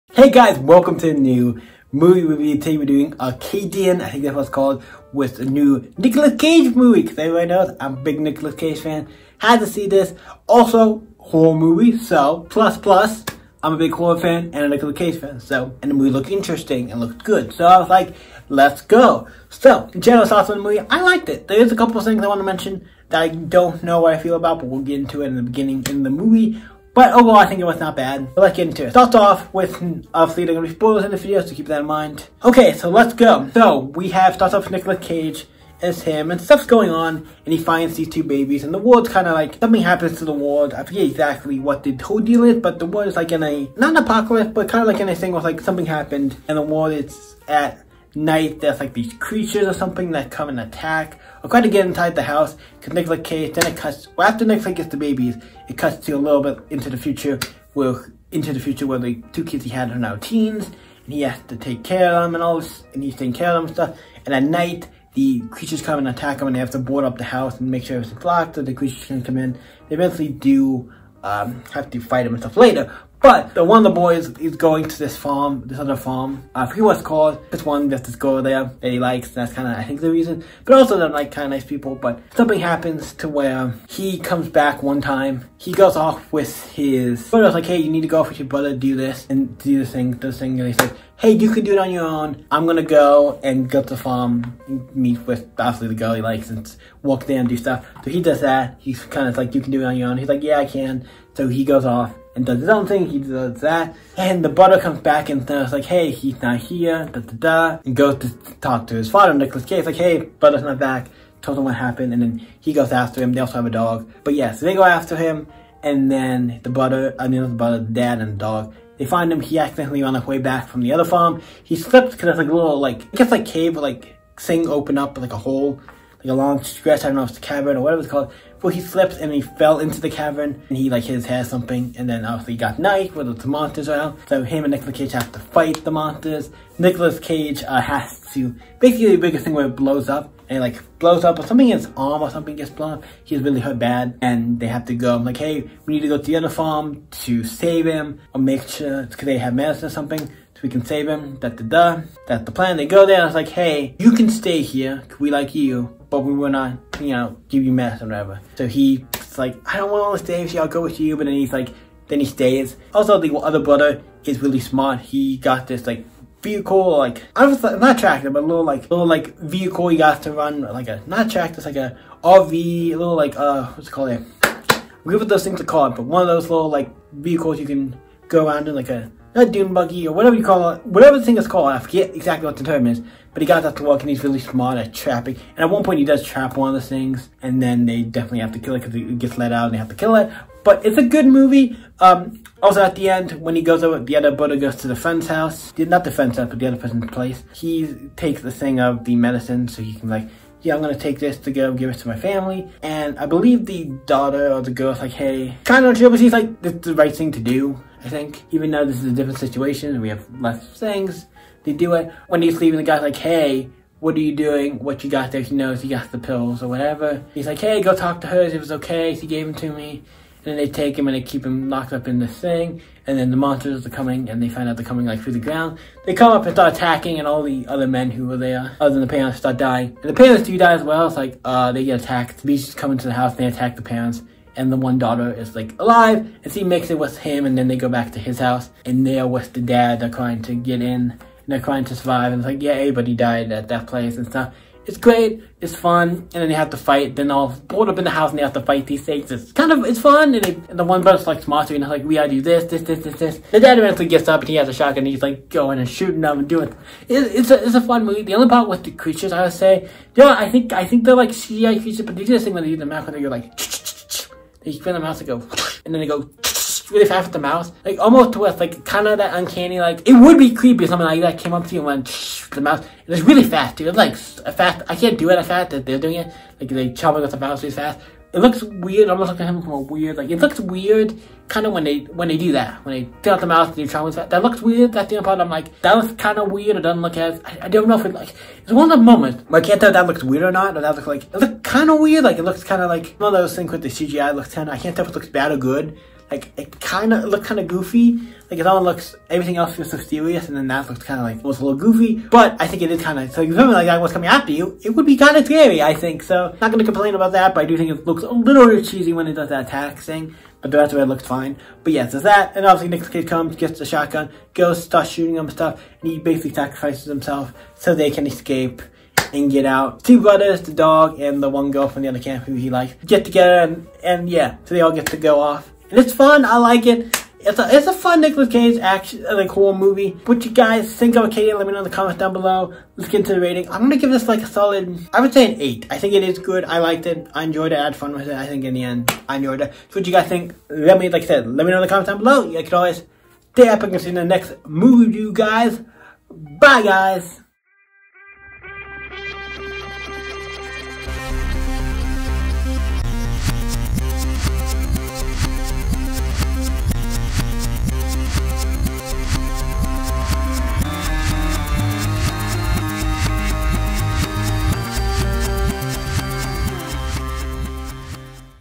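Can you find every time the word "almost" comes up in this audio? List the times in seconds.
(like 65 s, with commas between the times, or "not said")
267 s, 279 s.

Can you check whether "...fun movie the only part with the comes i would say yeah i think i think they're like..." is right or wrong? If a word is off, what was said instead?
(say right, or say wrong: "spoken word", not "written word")
wrong: "creatures", not "comes".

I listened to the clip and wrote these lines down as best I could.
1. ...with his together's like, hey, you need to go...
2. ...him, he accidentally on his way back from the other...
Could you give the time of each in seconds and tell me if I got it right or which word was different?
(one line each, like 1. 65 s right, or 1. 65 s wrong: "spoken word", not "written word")
1. 86 s wrong: "brother", not "together"
2. 119 s right.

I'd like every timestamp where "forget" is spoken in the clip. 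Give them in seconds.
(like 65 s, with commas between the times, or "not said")
40 s, 76 s, 181 s.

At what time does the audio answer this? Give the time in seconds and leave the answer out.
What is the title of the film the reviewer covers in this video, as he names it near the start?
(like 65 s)
3 s.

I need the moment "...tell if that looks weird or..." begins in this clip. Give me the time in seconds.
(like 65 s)
289 s.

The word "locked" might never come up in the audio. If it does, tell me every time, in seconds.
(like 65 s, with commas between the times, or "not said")
68 s, 221 s.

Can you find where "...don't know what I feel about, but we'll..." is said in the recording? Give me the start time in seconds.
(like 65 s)
23 s.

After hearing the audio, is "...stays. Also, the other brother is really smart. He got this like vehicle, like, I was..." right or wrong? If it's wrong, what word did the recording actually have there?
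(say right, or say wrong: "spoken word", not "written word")
right.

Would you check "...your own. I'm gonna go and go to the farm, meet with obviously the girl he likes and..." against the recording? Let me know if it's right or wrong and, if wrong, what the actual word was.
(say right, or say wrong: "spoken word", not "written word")
right.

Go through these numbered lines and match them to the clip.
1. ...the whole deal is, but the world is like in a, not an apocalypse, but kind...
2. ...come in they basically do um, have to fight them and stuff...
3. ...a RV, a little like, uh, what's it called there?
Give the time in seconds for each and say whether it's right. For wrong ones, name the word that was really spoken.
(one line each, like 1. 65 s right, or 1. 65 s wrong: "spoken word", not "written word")
1. 41 s right
2. 69 s wrong: "eventually", not "basically"
3. 171 s right.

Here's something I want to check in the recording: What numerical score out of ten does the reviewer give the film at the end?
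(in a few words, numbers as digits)
8.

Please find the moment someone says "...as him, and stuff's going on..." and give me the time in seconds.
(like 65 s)
35 s.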